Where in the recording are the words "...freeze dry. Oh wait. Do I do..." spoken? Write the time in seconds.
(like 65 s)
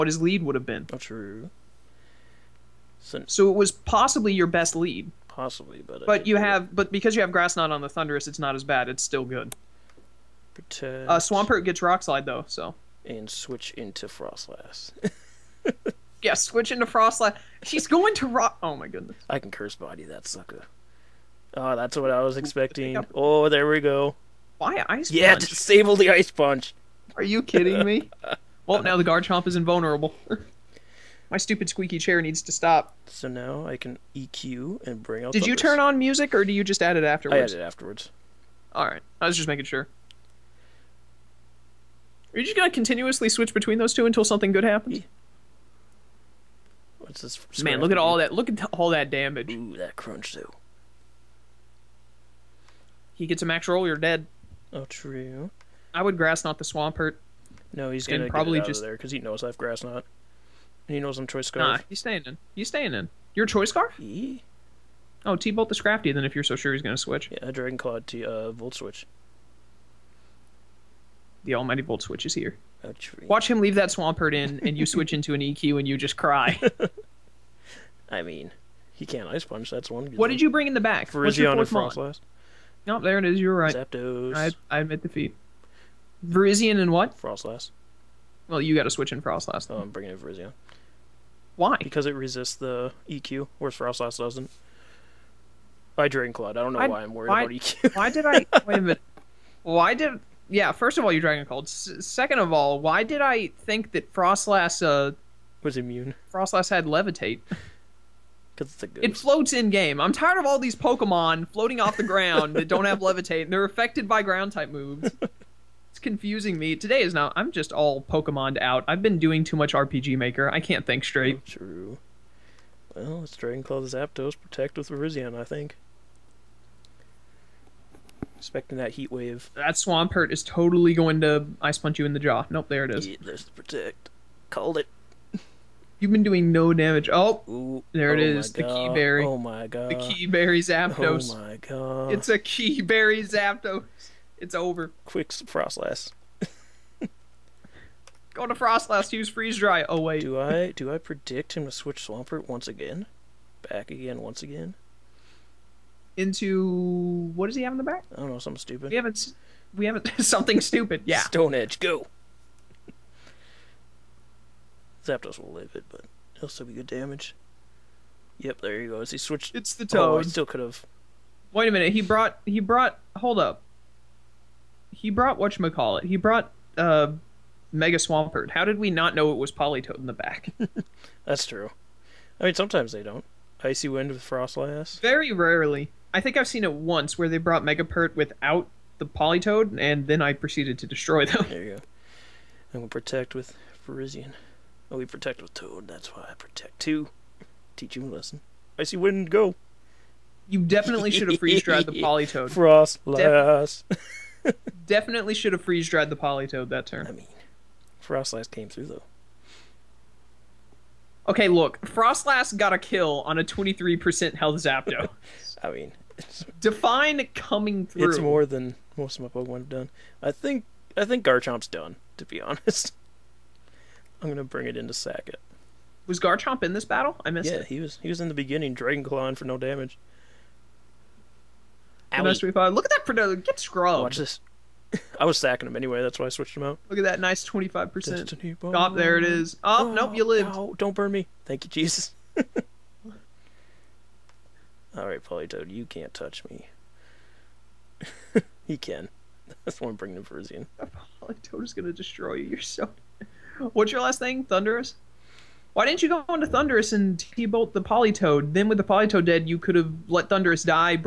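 149 s.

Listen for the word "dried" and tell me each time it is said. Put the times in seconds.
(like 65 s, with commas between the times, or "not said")
201 s, 205 s.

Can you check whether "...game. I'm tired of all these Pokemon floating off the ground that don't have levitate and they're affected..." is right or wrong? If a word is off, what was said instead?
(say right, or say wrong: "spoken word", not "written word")
right.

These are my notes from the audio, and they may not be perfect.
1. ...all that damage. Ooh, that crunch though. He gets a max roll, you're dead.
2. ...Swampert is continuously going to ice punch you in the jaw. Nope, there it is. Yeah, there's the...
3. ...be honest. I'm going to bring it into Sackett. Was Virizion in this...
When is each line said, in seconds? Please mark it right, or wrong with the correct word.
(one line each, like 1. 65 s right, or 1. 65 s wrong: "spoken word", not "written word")
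1. 48 s right
2. 129 s wrong: "totally", not "continuously"
3. 222 s wrong: "Garchomp", not "Virizion".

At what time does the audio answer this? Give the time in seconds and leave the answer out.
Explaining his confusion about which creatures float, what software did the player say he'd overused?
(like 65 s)
119 s.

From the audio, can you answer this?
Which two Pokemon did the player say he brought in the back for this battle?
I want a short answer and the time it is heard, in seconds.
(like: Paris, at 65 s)
Virizion and Froslass, at 81 s.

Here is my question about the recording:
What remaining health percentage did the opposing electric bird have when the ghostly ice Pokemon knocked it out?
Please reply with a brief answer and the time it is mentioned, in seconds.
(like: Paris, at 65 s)
23%, at 213 s.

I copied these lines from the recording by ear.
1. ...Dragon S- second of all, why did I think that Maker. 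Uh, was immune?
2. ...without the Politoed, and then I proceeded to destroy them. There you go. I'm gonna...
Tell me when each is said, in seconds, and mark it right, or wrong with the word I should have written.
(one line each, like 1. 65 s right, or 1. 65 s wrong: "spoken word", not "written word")
1. 101 s wrong: "Froslass", not "Maker"
2. 188 s right.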